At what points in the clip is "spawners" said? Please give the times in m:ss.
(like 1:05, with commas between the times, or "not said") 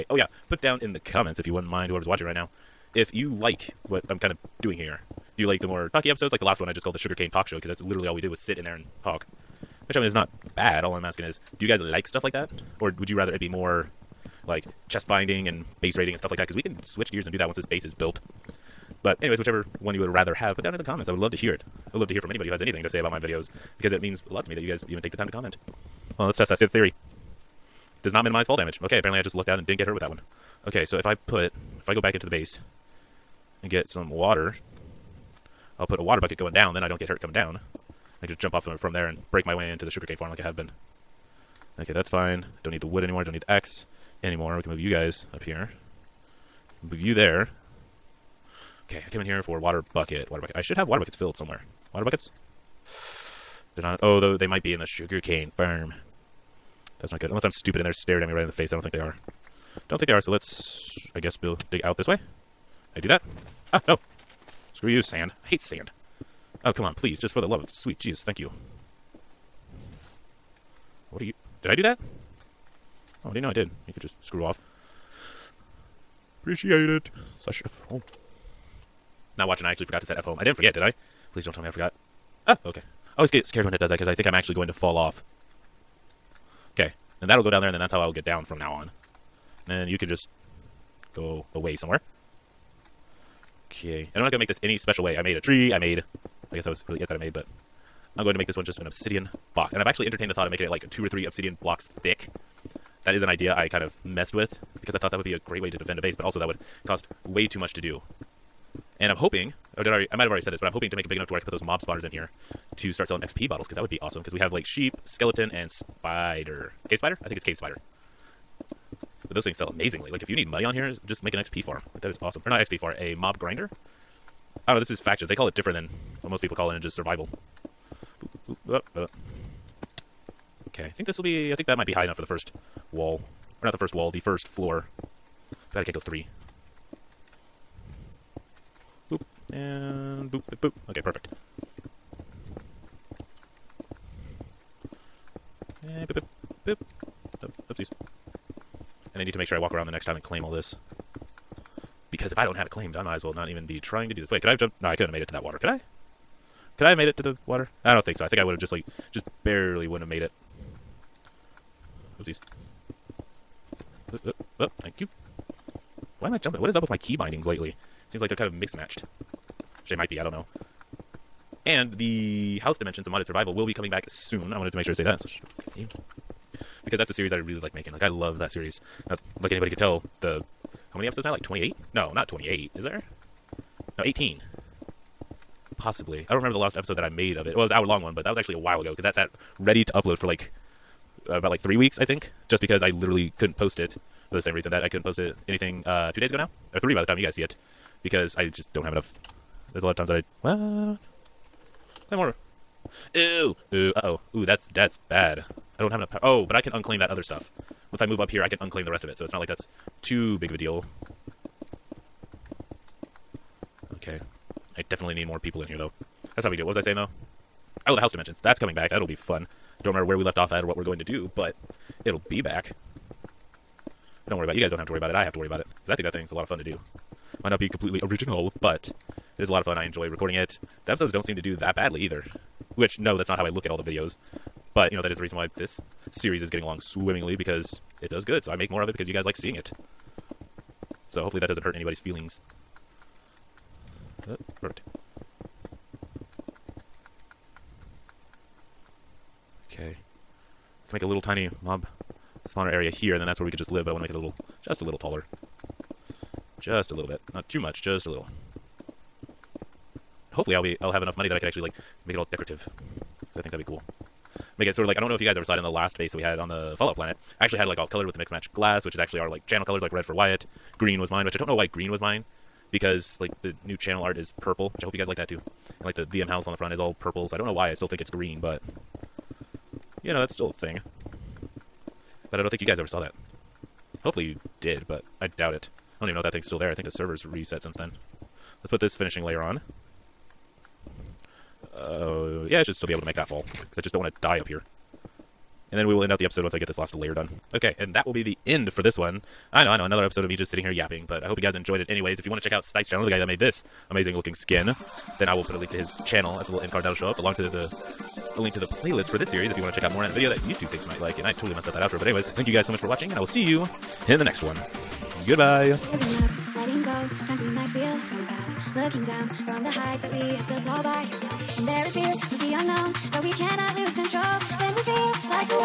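1:51, 4:12.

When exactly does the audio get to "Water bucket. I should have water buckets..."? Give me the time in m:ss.
0:50.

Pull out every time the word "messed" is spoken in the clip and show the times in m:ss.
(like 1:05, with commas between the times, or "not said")
1:44, 5:11.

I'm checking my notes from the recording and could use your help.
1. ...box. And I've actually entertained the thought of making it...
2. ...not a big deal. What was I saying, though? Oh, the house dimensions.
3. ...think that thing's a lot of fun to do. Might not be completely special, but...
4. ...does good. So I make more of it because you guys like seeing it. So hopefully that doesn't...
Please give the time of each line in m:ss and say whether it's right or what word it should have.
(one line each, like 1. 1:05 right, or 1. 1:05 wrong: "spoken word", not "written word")
1. 1:39 right
2. 3:36 right
3. 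3:45 wrong: "original", not "special"
4. 3:58 right.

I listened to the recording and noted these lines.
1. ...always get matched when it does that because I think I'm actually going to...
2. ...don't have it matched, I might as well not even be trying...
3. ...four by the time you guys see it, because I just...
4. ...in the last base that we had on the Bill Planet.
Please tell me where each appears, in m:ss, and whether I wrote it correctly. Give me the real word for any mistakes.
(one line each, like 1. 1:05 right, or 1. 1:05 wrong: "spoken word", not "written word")
1. 1:23 wrong: "scared", not "matched"
2. 2:32 wrong: "claimed", not "matched"
3. 3:16 wrong: "three", not "four"
4. 4:25 wrong: "Fallout", not "Bill".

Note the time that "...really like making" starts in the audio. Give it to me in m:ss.
2:57.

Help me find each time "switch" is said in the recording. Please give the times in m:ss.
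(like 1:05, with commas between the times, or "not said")
0:16.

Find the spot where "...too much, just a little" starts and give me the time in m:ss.
4:17.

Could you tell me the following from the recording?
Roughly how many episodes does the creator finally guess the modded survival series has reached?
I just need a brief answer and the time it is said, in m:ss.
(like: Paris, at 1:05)
18, at 3:04.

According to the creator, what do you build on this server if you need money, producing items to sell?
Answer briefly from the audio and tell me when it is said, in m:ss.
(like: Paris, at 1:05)
A mob grinder, at 2:03.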